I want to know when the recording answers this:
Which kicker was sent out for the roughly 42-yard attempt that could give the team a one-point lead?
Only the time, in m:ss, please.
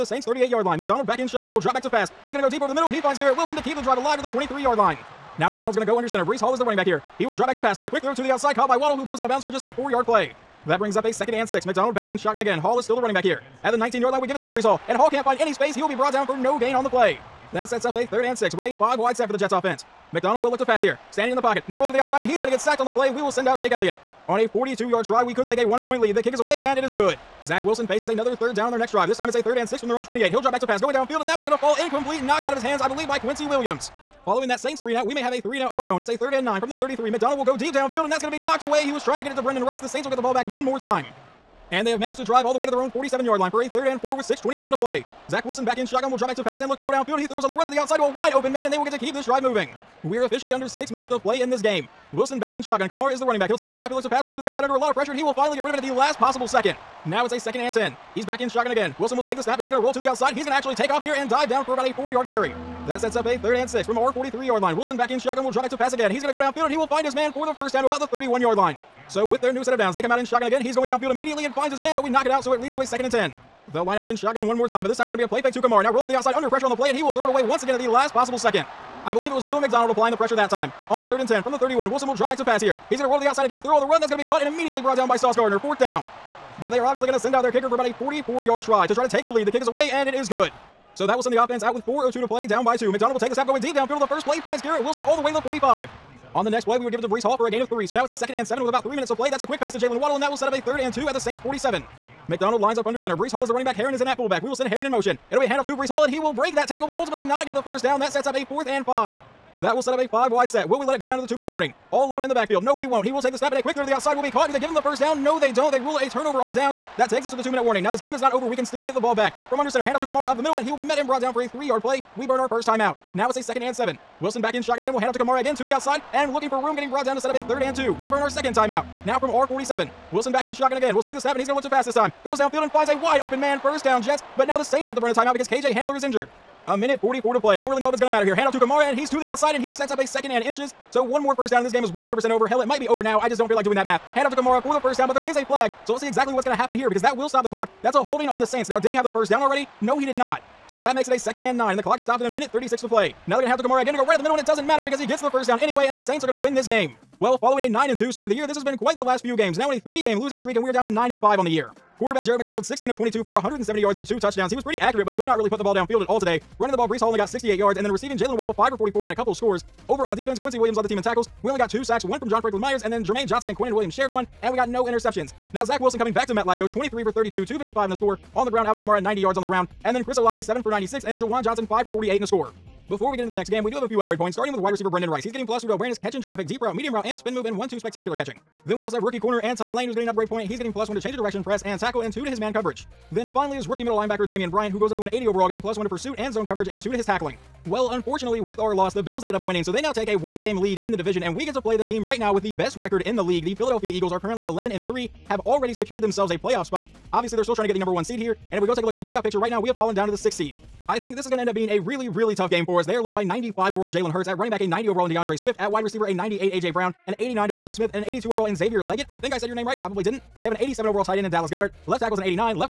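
0:23.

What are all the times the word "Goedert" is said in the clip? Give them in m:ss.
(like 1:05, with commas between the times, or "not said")
3:41.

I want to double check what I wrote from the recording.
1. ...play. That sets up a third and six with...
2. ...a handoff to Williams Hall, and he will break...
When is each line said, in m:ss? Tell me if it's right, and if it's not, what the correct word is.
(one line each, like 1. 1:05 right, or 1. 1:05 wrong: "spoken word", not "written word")
1. 0:16 right
2. 1:45 wrong: "Breece", not "Williams".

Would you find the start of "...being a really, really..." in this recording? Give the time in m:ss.
3:31.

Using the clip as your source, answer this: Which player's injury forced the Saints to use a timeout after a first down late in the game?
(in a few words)
KJ Hamler.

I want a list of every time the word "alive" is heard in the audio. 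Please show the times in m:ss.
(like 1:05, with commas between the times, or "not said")
0:03.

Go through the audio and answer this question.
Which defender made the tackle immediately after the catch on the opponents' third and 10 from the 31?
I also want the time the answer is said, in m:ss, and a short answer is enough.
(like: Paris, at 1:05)
Sauce Gardner, at 1:25.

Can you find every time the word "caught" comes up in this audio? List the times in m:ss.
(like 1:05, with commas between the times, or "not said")
0:08, 1:24, 1:54.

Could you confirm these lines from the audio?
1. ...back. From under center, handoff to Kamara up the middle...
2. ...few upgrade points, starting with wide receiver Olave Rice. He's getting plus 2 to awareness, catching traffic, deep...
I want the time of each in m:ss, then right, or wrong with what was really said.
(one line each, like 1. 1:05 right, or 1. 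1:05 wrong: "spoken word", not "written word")
1. 1:59 right
2. 3:03 wrong: "Brendan", not "Olave".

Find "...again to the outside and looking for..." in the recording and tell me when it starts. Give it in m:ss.
2:05.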